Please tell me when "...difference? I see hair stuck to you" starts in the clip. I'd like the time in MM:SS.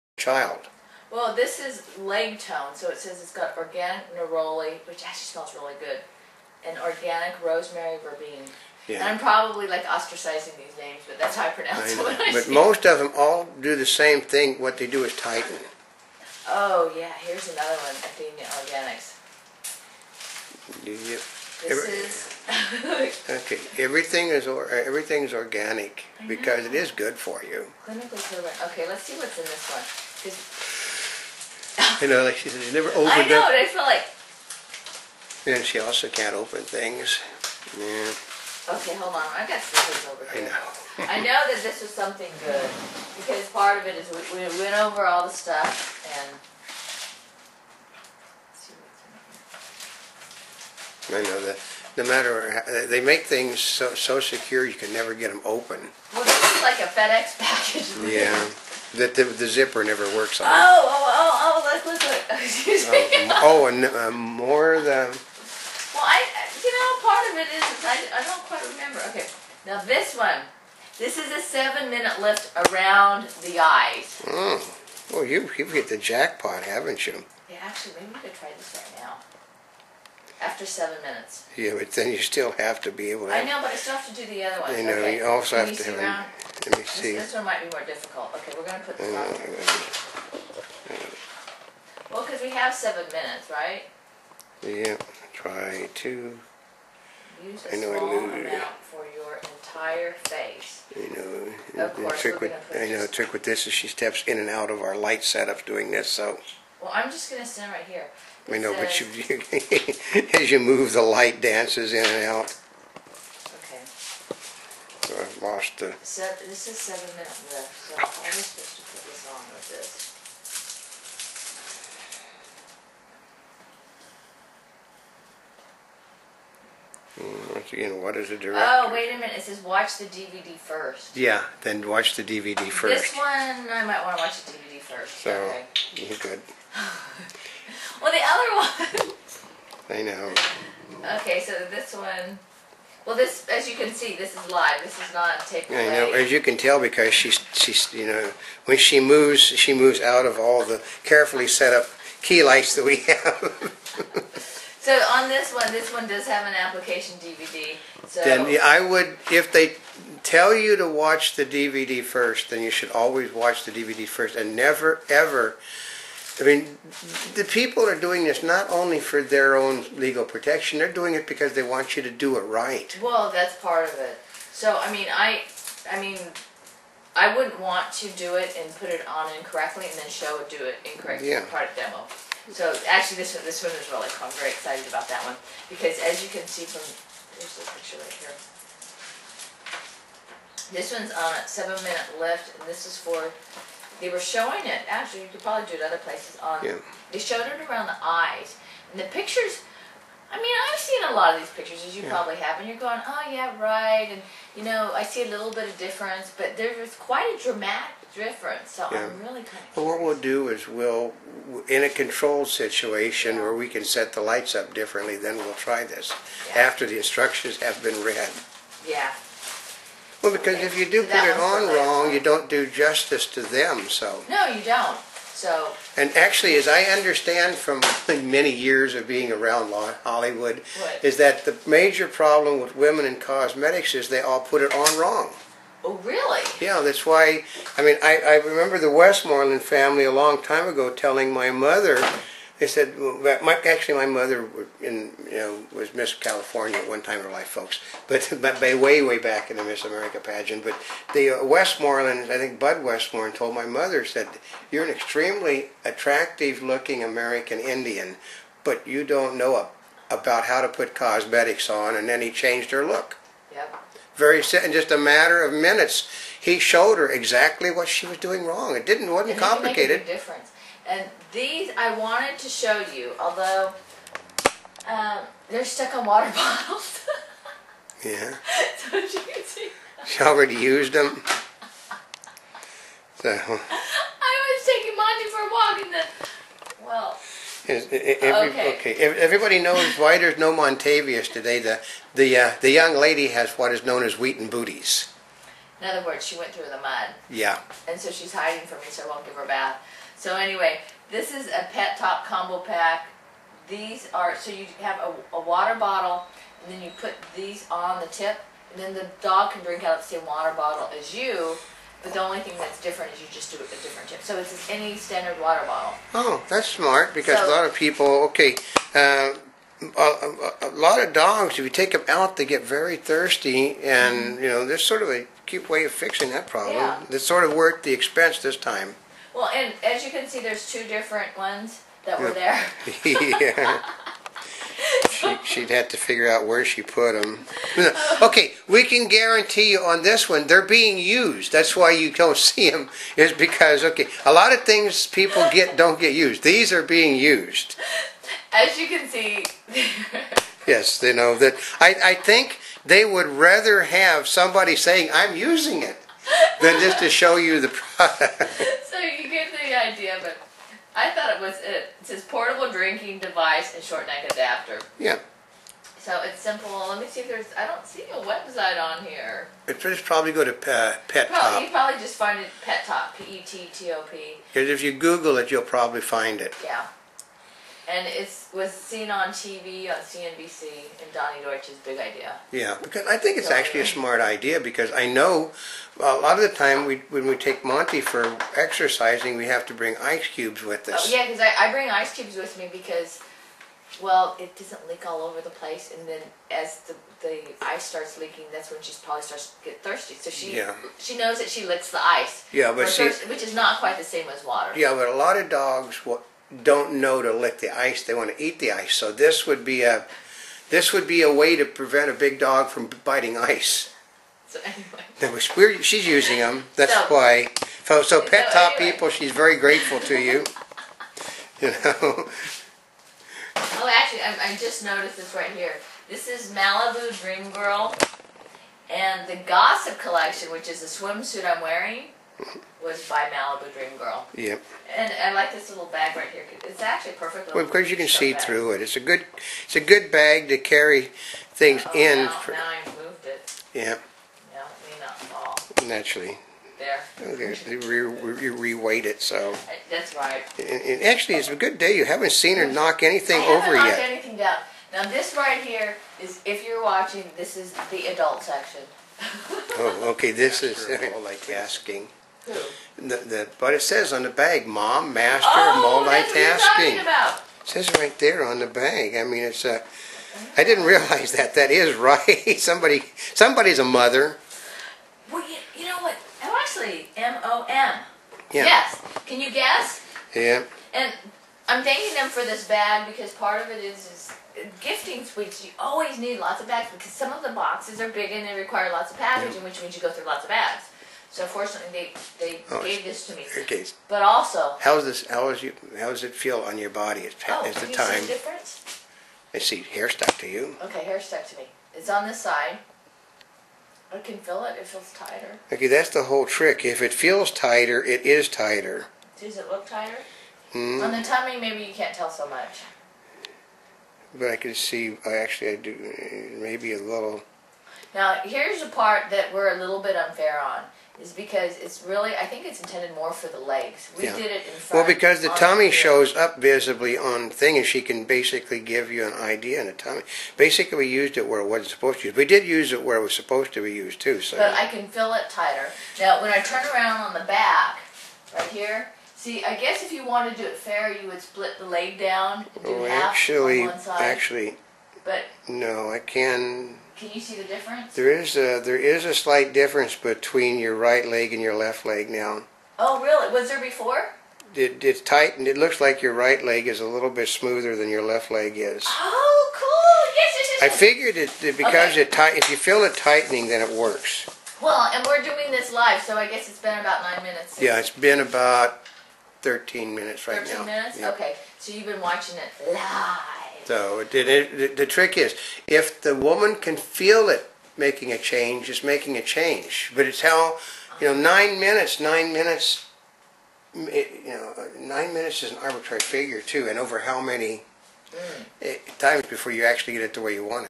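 08:18.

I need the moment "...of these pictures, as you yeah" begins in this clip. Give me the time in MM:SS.
03:21.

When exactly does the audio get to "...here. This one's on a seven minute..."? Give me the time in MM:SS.
03:08.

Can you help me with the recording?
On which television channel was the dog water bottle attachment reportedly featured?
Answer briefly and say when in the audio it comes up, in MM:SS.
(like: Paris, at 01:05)
CNBC, at 06:19.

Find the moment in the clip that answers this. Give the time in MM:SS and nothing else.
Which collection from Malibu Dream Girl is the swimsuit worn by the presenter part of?
07:09.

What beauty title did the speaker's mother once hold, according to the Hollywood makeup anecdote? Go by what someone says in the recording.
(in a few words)
Miss California.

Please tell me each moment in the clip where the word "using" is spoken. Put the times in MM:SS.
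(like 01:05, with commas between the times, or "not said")
05:55, 06:56.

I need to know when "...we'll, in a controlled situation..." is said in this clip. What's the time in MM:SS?
03:30.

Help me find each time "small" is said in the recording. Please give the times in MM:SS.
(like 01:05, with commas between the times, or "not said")
01:37.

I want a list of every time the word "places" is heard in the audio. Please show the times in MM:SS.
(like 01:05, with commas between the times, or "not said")
03:15, 06:35.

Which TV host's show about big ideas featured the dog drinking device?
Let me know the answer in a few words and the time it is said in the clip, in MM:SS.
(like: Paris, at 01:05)
Donny Deutsch, at 06:21.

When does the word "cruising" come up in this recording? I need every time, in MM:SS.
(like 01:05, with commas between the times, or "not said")
not said.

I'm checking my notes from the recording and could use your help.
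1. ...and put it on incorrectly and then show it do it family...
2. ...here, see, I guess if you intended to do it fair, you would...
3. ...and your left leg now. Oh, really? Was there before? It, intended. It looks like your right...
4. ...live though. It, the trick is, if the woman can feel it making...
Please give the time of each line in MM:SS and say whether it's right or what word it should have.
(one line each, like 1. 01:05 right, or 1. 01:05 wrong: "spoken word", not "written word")
1. 02:58 wrong: "incorrectly", not "family"
2. 08:58 wrong: "wanted", not "intended"
3. 09:11 wrong: "tightened", not "intended"
4. 09:32 right.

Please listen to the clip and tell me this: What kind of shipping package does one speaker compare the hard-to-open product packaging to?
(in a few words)
FedEx package.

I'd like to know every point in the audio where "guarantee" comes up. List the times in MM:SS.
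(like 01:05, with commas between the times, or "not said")
05:39.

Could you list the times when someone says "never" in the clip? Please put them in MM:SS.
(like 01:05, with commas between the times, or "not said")
00:32, 00:54, 00:59, 02:44.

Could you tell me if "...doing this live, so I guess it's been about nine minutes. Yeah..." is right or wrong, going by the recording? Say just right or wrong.
right.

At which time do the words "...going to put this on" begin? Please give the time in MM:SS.
01:28.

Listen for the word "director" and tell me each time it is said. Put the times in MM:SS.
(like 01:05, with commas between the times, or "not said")
02:08.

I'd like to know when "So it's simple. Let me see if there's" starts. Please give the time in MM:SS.
06:05.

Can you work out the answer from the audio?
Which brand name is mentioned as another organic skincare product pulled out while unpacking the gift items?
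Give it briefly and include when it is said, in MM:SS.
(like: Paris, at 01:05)
Athena Organics, at 00:17.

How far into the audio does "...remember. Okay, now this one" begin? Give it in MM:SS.
01:08.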